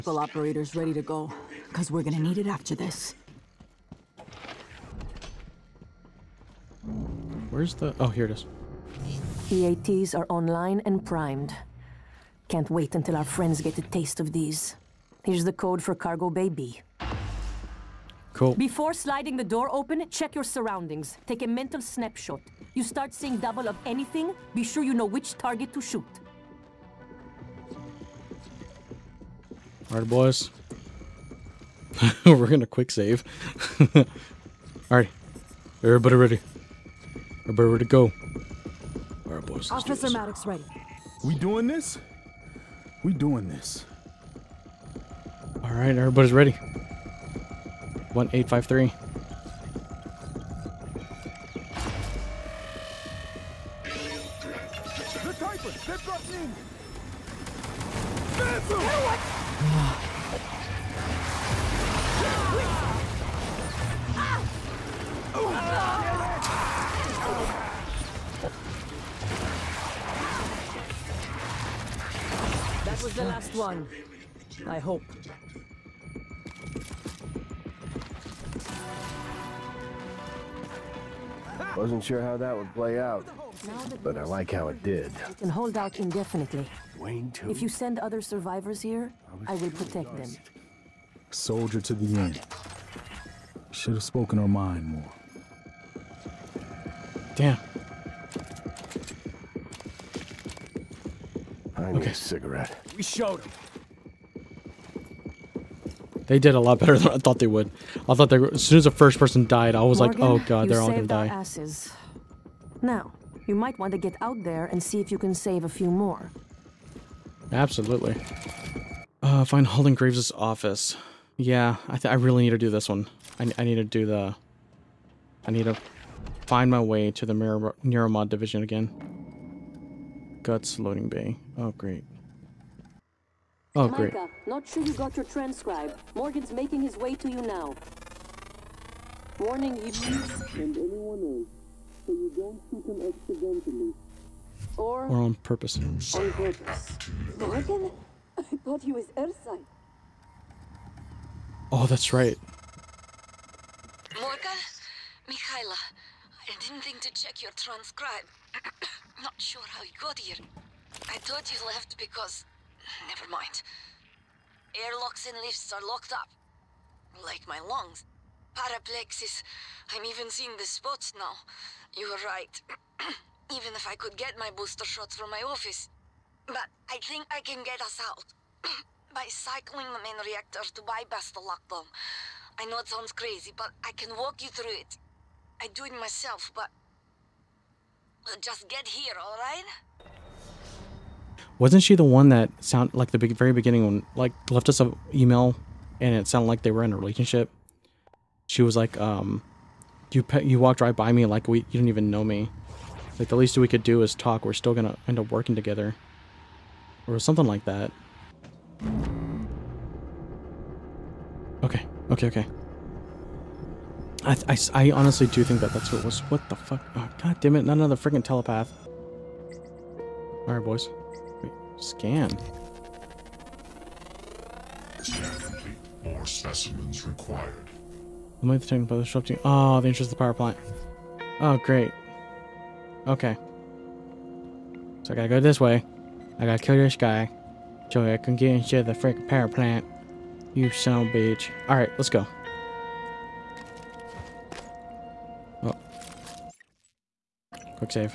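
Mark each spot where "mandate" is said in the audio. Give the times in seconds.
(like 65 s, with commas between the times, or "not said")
not said.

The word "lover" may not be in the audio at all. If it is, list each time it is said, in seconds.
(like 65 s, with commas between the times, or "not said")
not said.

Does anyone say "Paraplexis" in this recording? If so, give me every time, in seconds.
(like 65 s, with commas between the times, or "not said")
168 s.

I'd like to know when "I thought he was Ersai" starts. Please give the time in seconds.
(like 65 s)
148 s.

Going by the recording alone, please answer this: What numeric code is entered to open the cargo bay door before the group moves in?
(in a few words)
1853.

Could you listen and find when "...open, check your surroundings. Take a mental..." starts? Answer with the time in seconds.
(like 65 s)
19 s.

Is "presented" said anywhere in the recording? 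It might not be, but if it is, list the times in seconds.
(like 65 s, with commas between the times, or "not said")
not said.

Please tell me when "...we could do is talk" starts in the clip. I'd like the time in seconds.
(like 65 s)
203 s.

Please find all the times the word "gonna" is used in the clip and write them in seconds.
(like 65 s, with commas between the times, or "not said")
2 s, 32 s, 110 s, 204 s.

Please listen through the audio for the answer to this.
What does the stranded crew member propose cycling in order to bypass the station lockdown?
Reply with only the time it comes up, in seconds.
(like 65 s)
180 s.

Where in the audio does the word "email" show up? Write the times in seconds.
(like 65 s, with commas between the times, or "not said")
195 s.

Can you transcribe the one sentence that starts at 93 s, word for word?
Should have spoken her mind more.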